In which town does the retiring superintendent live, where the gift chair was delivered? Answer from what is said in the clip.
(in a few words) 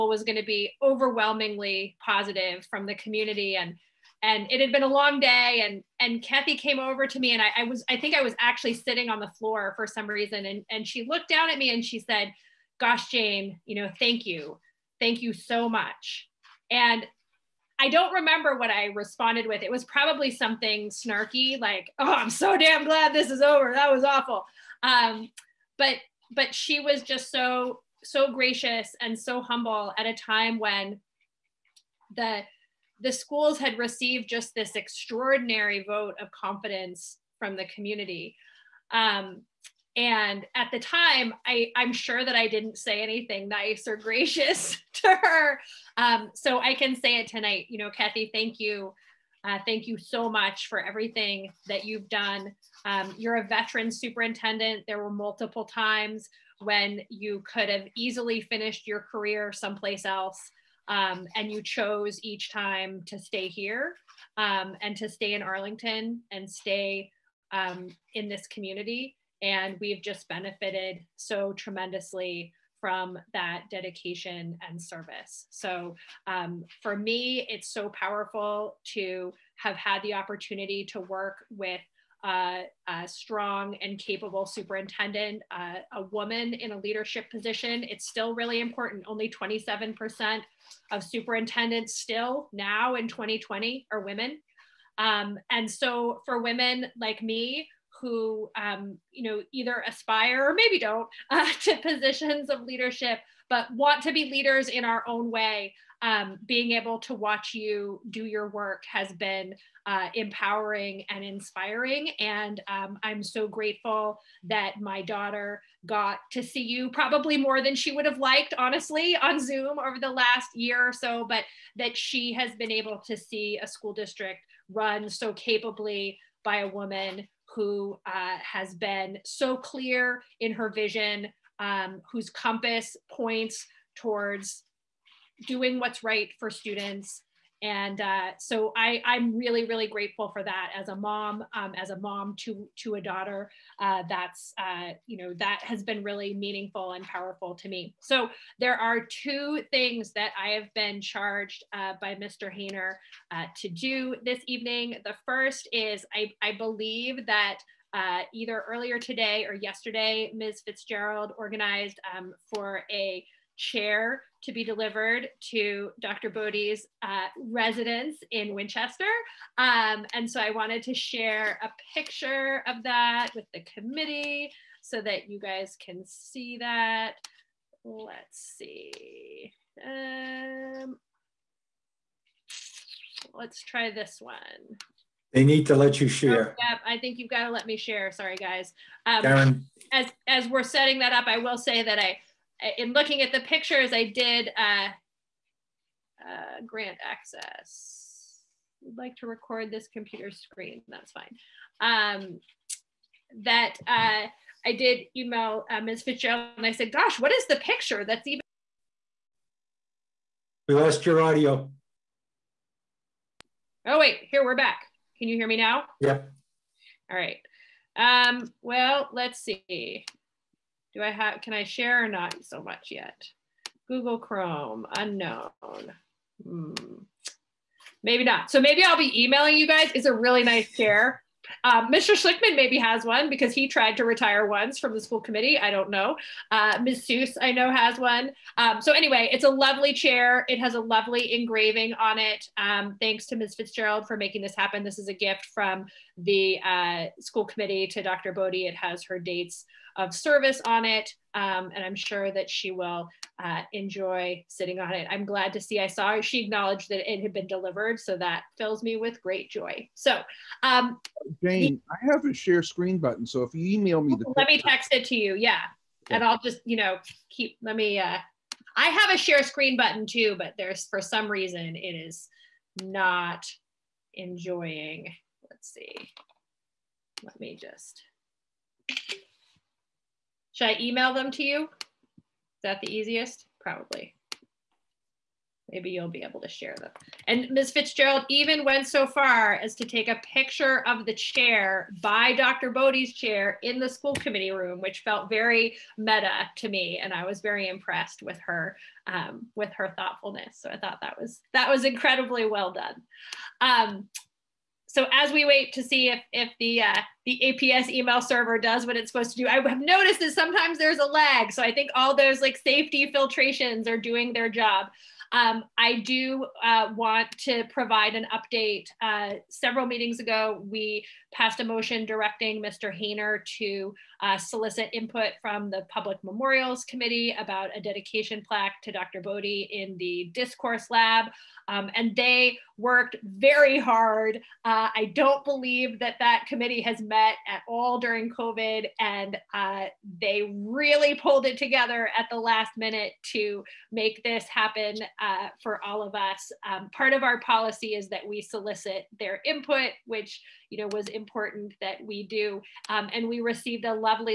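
Winchester.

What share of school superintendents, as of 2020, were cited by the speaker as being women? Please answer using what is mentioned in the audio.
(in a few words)
27%.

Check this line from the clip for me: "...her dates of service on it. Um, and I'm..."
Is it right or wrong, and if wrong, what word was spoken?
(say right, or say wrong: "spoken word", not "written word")
right.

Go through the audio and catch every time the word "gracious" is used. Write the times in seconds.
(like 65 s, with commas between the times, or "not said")
28 s, 43 s.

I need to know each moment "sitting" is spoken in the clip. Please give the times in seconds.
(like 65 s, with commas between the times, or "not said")
8 s, 254 s.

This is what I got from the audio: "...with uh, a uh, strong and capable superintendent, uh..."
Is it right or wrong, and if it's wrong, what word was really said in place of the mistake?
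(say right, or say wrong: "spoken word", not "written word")
right.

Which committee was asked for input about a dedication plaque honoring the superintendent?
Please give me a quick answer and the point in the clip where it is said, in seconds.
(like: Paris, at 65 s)
Public Memorials Committee, at 325 s.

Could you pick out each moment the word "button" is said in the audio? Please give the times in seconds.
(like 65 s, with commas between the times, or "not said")
262 s, 269 s.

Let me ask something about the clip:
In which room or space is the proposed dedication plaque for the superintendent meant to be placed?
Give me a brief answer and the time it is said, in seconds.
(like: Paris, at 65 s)
Discourse Lab, at 330 s.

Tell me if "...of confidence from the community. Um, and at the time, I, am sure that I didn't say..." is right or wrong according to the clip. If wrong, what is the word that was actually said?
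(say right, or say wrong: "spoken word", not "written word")
right.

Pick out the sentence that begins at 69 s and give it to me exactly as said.
And we've just benefited so tremendously from that dedication and service.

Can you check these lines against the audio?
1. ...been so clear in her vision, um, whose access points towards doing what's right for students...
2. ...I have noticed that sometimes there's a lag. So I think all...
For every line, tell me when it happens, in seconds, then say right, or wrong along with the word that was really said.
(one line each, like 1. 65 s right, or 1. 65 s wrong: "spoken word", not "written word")
1. 128 s wrong: "compass", not "access"
2. 309 s right.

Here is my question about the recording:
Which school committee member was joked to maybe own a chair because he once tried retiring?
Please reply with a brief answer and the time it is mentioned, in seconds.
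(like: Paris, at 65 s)
Mr. Schlichtman, at 231 s.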